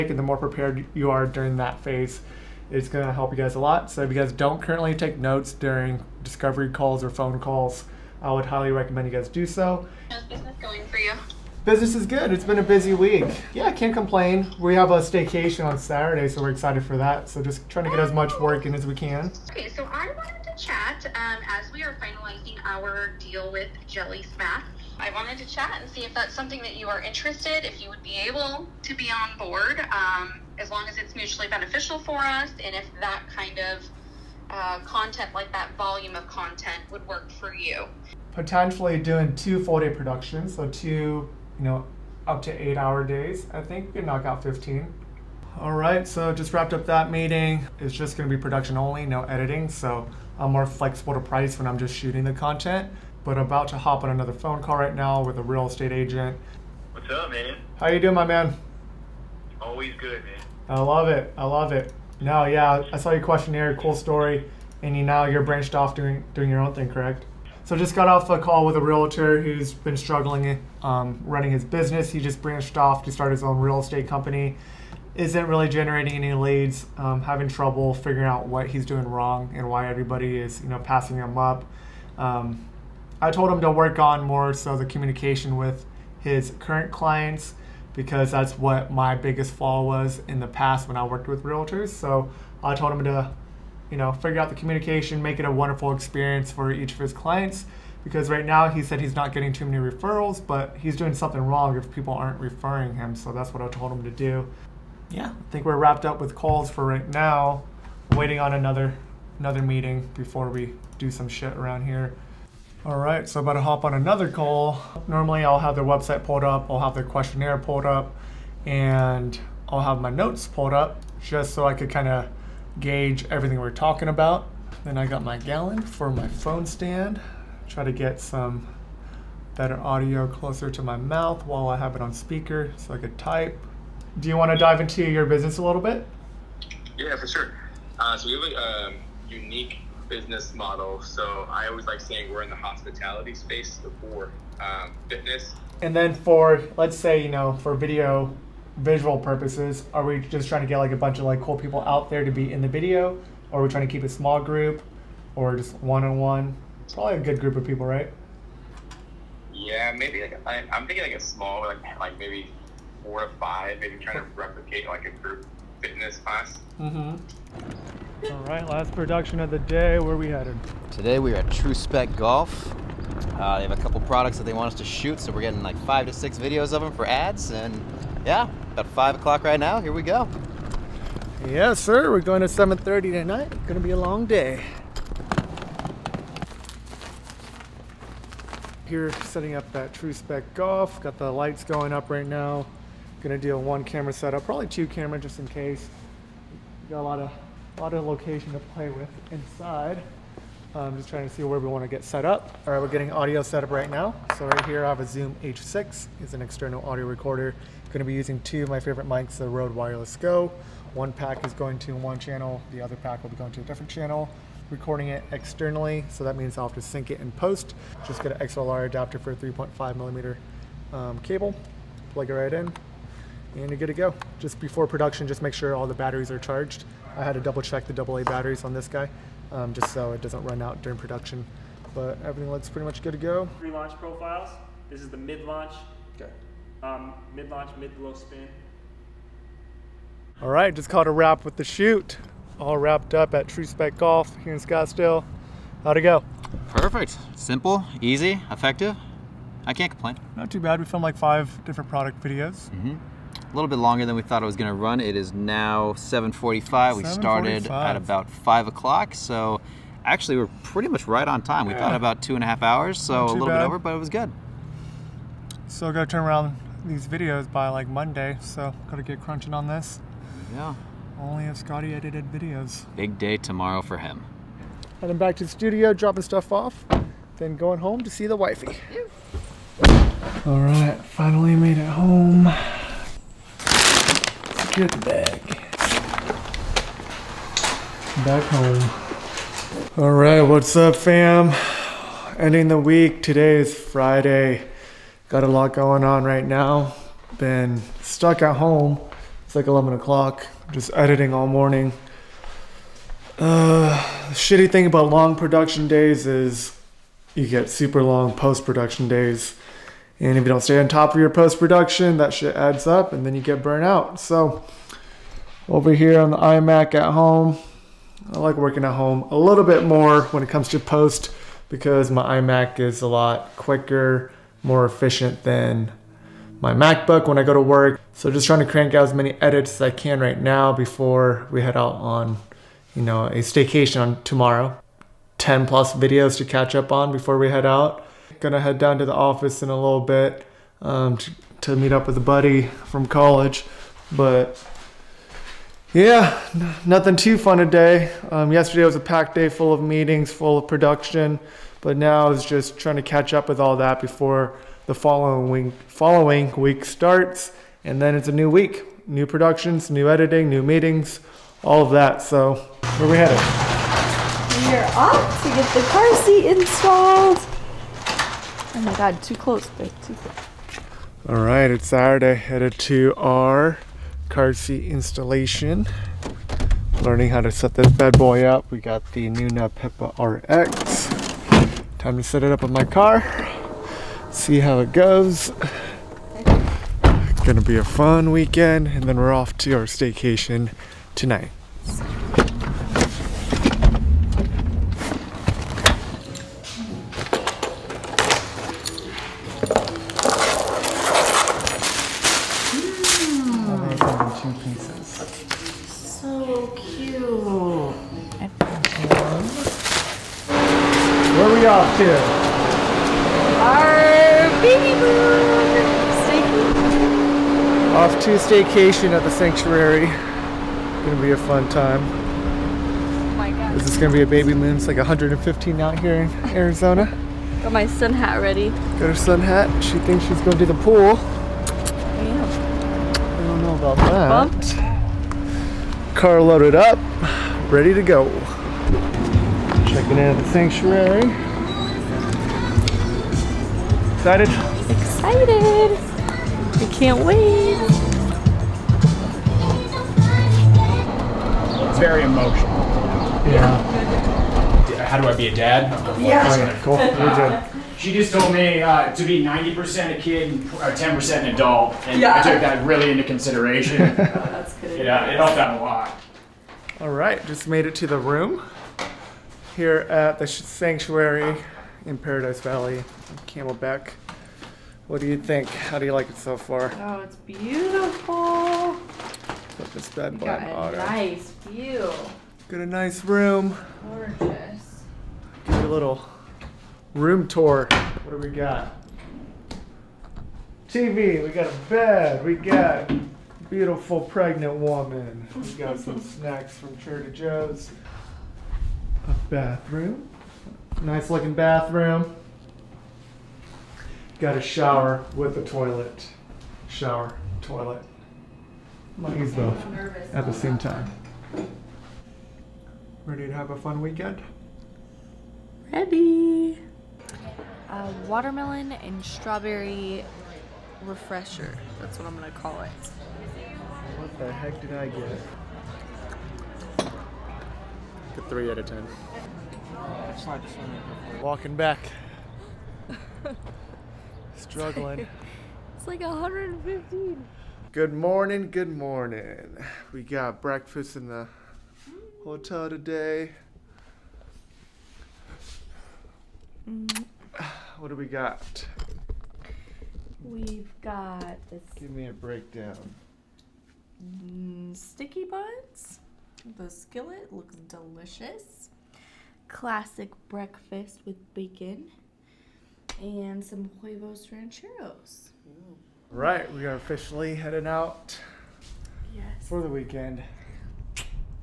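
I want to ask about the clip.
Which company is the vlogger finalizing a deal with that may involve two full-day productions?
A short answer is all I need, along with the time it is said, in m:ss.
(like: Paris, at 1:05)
Jelly Smack, at 0:23.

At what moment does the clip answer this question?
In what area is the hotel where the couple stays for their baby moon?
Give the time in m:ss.
7:52.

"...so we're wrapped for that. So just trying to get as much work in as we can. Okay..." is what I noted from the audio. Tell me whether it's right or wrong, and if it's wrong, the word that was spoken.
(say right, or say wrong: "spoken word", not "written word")
wrong: "excited", not "wrapped".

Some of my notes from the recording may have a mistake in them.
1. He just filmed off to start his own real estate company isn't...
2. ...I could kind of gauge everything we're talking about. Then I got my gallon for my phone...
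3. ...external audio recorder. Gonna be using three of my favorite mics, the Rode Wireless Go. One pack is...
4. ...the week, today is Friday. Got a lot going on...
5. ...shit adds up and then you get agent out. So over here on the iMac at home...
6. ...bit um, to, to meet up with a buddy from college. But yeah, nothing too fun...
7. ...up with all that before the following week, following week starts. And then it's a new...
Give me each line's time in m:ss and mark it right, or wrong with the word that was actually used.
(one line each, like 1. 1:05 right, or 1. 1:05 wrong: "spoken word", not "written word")
1. 1:12 wrong: "branched", not "filmed"
2. 2:01 right
3. 3:26 wrong: "two", not "three"
4. 4:52 right
5. 5:12 wrong: "burnt", not "agent"
6. 5:39 right
7. 5:53 right.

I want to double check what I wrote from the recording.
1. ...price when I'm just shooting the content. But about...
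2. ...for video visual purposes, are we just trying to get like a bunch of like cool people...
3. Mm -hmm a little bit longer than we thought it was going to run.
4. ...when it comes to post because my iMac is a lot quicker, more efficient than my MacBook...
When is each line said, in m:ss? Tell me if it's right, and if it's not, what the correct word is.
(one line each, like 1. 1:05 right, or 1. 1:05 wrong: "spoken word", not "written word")
1. 0:51 right
2. 2:27 right
3. 4:12 right
4. 5:20 right.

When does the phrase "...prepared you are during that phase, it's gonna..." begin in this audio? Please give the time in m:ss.
0:00.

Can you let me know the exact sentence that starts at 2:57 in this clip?
And yeah, about five o'clock right now.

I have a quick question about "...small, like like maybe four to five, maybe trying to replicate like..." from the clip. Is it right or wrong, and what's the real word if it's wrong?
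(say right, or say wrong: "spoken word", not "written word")
right.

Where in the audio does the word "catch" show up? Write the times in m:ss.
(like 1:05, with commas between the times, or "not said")
5:36, 5:53.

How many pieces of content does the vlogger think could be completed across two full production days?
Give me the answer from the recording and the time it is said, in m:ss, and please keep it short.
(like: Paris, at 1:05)
15, at 0:44.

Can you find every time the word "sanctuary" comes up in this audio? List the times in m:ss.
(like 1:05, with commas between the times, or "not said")
6:59, 7:20, 7:50.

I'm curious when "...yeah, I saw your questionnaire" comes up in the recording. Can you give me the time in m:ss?
1:02.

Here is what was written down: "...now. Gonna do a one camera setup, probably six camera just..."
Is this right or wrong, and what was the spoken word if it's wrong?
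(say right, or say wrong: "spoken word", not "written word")
wrong: "two", not "six".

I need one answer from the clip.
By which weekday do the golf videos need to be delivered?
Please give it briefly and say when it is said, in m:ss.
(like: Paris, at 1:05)
Monday, at 4:27.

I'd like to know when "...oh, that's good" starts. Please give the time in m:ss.
7:44.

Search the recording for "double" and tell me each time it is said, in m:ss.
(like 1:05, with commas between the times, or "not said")
3:47.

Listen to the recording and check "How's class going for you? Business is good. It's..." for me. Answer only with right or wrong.
wrong.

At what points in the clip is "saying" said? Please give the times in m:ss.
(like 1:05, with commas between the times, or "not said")
2:21.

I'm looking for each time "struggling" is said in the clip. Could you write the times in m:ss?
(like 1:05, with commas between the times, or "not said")
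1:09, 8:54.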